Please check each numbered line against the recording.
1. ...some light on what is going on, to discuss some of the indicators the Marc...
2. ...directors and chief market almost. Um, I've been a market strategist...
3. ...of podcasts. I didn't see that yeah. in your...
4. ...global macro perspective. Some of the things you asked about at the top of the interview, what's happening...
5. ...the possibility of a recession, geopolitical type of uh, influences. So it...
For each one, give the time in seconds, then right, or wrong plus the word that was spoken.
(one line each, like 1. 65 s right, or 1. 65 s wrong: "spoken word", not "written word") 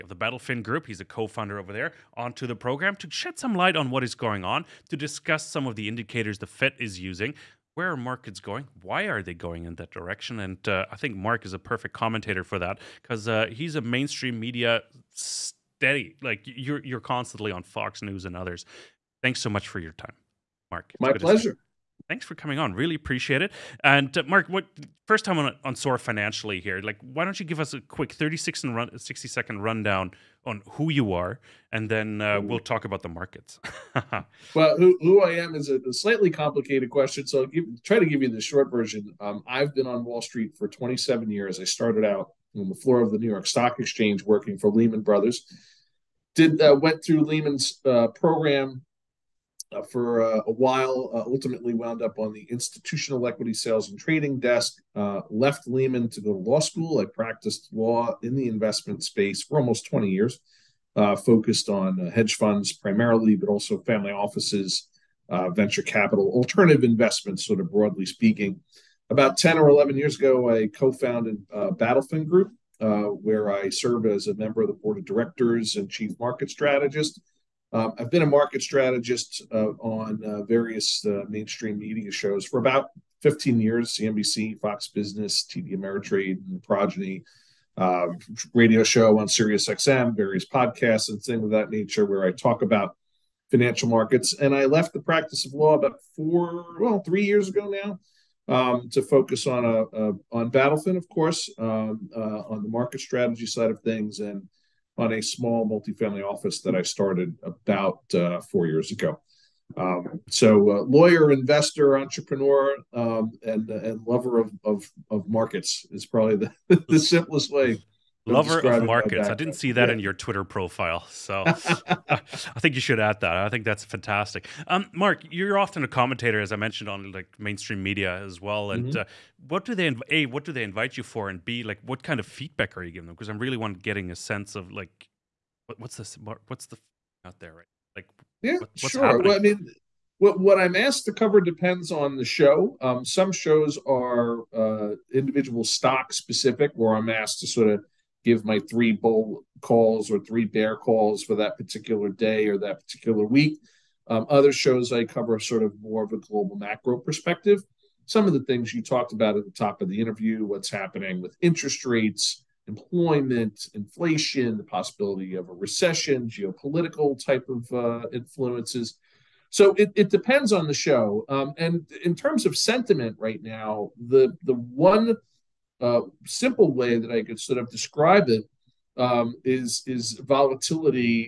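1. 3 s wrong: "Fed", not "Marc"
2. 75 s wrong: "strategist", not "almost"
3. 118 s wrong: "markets", not "podcasts"
4. 156 s wrong: "talked", not "asked"
5. 164 s right.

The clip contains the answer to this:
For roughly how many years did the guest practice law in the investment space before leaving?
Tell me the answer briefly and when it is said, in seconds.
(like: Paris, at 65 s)
20 years, at 59 s.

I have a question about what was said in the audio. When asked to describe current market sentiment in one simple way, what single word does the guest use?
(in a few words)
volatility.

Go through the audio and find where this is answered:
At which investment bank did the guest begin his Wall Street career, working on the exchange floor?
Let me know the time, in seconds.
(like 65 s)
44 s.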